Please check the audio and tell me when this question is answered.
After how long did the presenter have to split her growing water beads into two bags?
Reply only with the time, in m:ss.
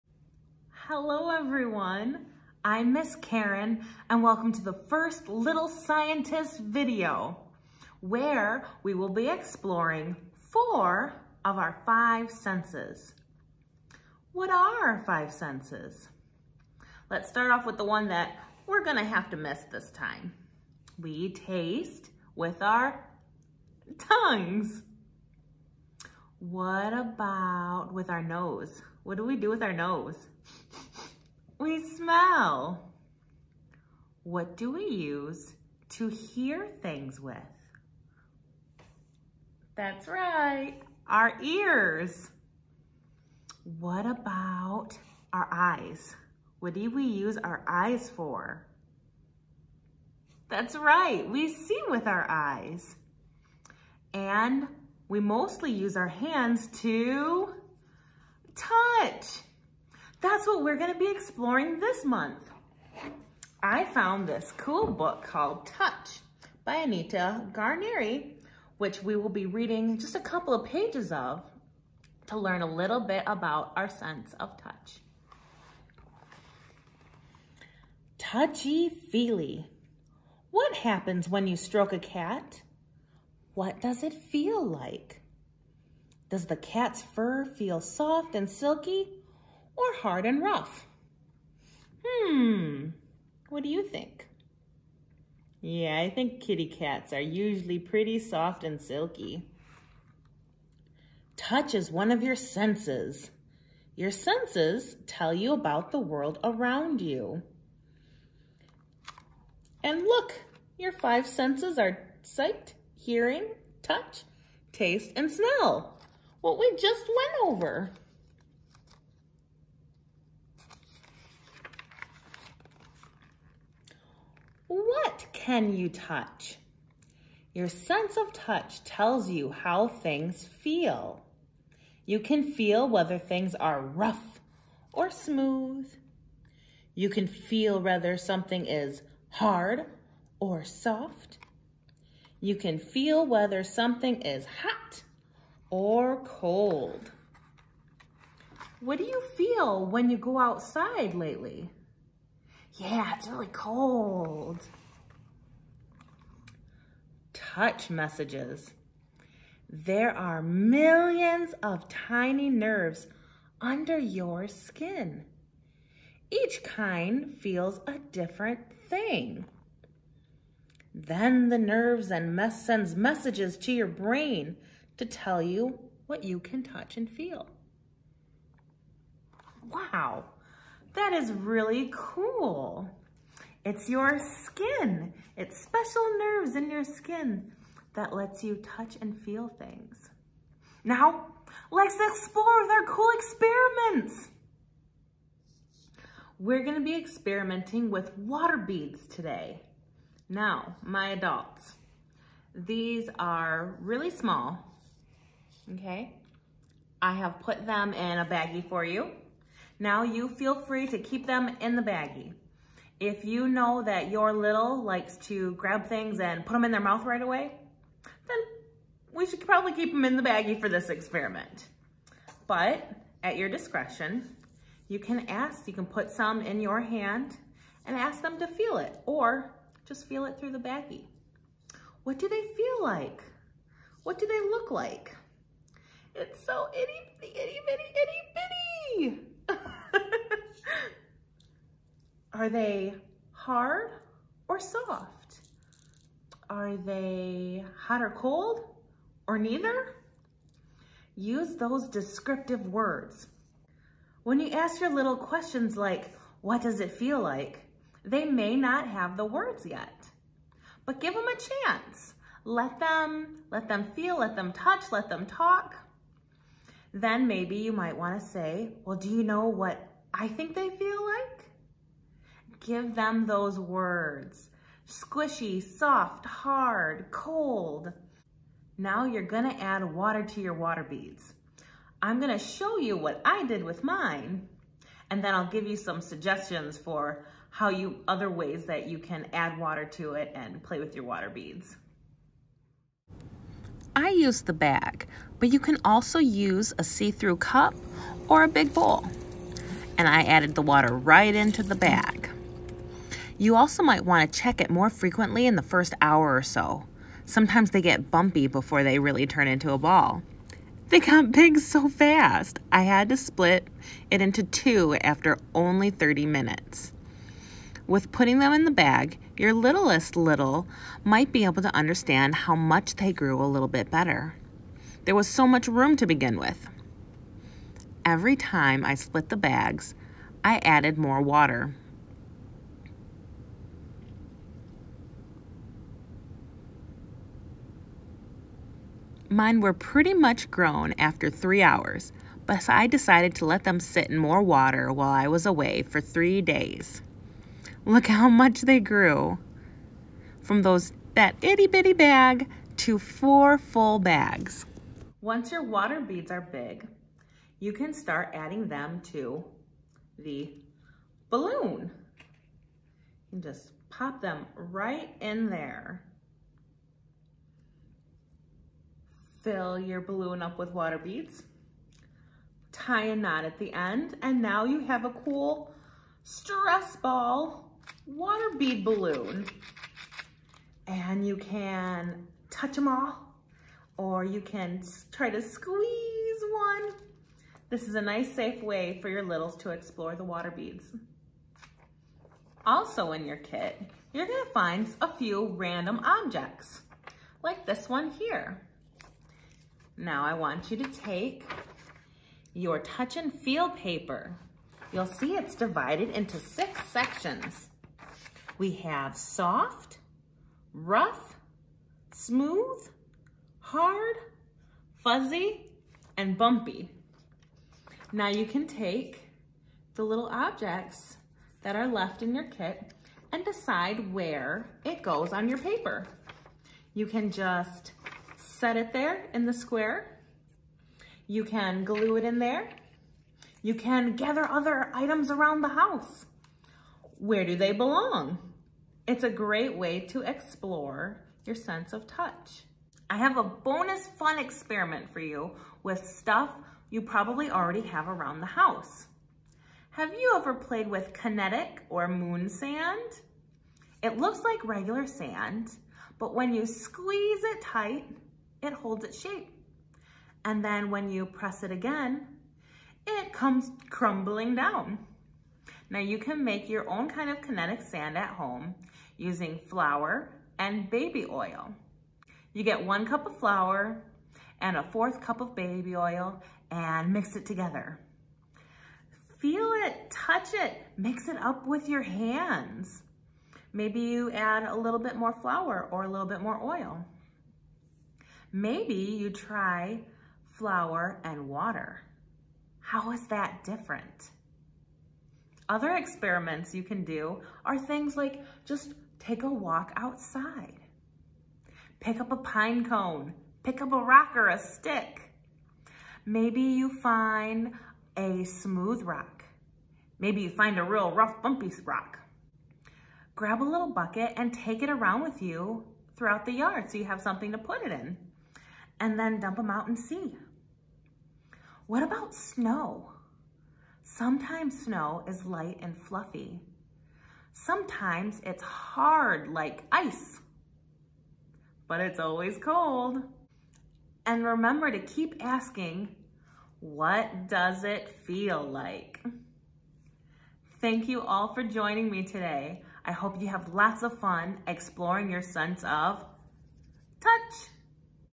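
5:15.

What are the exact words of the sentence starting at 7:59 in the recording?
Feel it, touch it, mix it up with your hands.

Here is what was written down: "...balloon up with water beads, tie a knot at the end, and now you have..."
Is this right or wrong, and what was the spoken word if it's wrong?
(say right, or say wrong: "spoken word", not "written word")
right.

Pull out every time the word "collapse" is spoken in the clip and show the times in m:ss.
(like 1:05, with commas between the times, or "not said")
not said.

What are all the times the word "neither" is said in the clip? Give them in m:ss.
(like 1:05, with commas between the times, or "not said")
4:09.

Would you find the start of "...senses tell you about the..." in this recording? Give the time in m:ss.
1:44.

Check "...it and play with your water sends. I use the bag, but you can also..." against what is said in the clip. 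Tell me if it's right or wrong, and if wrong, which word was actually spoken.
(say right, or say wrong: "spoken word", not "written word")
wrong: "beads", not "sends".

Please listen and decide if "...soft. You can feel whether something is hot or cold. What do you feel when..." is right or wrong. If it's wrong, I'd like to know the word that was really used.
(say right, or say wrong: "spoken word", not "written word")
right.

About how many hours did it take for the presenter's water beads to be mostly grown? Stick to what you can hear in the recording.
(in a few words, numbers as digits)
3 hours.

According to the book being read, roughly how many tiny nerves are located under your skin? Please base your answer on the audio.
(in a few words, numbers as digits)
millions.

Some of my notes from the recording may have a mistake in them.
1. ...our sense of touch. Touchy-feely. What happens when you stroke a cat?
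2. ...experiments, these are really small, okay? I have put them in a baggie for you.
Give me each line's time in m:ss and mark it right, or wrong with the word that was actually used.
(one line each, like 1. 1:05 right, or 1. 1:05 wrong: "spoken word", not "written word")
1. 1:13 right
2. 3:21 wrong: "adults", not "experiments".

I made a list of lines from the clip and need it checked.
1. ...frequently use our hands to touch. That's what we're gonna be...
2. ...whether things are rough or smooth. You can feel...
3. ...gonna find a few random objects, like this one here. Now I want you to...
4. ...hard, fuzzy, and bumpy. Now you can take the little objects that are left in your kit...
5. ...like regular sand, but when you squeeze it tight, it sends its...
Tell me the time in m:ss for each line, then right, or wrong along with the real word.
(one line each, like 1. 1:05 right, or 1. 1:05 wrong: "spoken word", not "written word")
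1. 0:55 wrong: "mostly", not "frequently"
2. 2:12 right
3. 6:34 right
4. 6:53 right
5. 7:34 wrong: "holds", not "sends".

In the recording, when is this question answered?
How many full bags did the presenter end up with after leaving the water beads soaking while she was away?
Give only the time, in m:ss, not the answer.
5:52.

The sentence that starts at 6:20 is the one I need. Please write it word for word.
And you can touch them all, or you can try to squeeze one.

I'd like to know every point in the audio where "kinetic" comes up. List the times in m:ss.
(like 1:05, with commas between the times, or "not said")
7:31, 7:47.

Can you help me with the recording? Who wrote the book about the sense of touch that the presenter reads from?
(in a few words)
Anita Ganeri.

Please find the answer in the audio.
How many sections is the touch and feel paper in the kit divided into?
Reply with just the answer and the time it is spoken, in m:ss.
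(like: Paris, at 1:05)
6, at 6:46.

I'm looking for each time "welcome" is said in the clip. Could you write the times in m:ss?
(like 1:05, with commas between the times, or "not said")
0:04.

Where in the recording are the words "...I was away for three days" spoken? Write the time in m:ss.
5:45.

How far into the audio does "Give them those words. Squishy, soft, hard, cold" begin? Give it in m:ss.
4:32.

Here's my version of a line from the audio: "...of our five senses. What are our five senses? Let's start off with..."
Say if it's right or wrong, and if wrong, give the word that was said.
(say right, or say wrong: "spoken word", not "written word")
right.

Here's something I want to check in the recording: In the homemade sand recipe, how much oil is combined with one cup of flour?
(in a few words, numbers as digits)
1/4 cup.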